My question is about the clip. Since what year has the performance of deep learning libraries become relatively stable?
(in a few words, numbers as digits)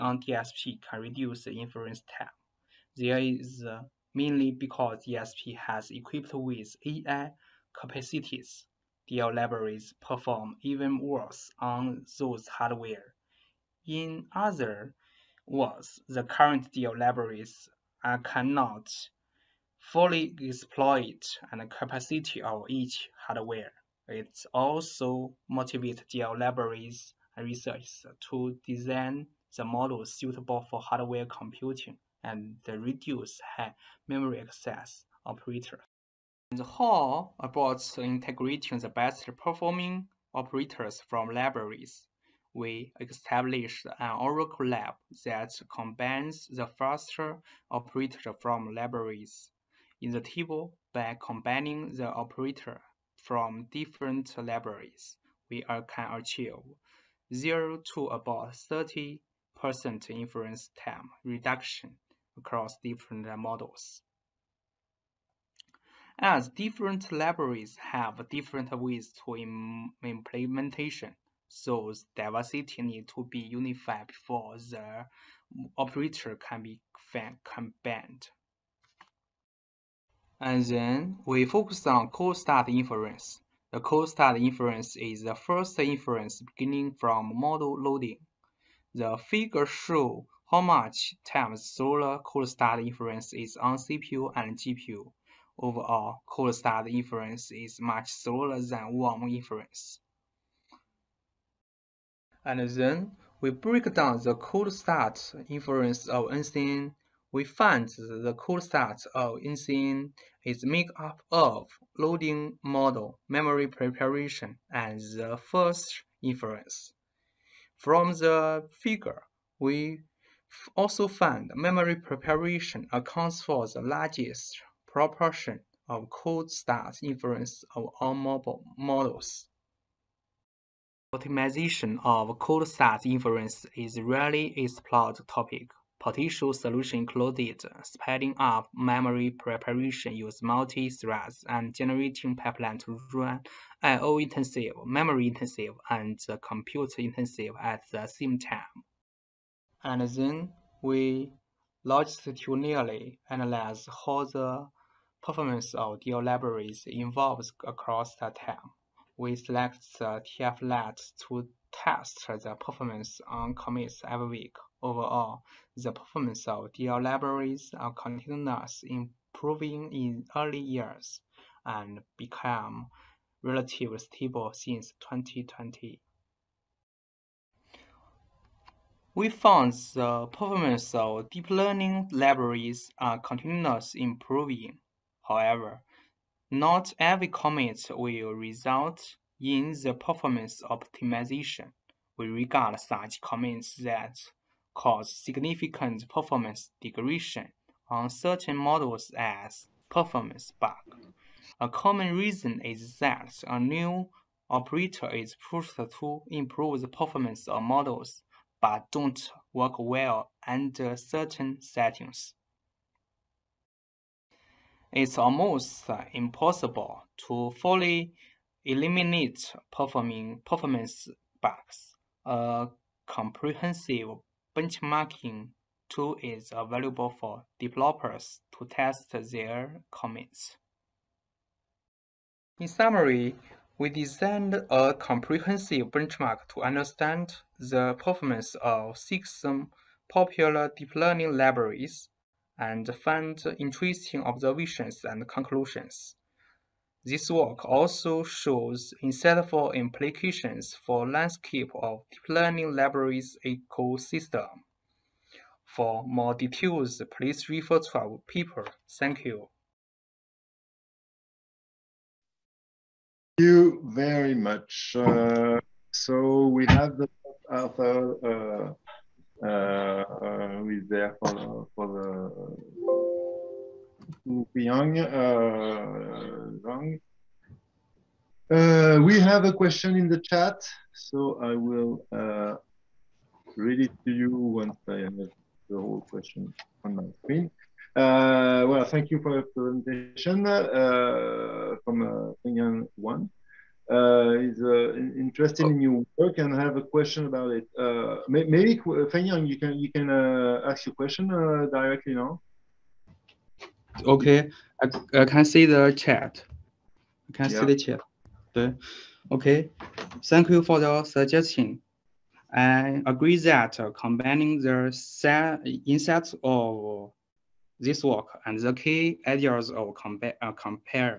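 2020.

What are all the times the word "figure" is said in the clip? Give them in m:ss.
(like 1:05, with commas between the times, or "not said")
1:29, 1:58.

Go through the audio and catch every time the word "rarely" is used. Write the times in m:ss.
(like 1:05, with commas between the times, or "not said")
2:14.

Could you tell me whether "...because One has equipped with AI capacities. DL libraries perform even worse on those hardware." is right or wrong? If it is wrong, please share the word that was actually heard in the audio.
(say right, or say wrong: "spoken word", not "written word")
wrong: "DSP", not "One".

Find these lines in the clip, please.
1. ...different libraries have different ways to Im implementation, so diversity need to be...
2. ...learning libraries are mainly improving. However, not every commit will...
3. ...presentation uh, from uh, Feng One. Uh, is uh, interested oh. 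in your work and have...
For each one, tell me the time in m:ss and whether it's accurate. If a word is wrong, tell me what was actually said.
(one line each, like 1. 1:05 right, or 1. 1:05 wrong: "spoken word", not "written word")
1. 1:06 right
2. 3:01 wrong: "continuously", not "mainly"
3. 4:49 right.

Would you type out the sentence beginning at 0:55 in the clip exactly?
We can achieve 0 to about 30 person to time reduction across different models.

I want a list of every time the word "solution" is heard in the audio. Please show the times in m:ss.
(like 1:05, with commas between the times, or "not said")
2:16.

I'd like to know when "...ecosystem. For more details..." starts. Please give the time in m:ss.
4:13.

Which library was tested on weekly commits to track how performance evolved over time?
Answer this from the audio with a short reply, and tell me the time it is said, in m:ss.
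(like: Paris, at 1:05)
TFLite, at 2:40.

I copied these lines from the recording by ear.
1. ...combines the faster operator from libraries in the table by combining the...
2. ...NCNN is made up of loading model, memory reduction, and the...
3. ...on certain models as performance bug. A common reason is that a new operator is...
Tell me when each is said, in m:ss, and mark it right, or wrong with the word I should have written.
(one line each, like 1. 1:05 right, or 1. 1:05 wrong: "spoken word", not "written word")
1. 0:45 right
2. 1:49 wrong: "preparation", not "reduction"
3. 3:17 right.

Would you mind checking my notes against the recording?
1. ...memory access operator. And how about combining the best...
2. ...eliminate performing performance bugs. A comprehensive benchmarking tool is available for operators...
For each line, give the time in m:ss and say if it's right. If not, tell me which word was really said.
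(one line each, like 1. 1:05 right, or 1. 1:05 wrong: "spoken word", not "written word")
1. 0:34 wrong: "integrating", not "combining"
2. 3:38 wrong: "developers", not "operators".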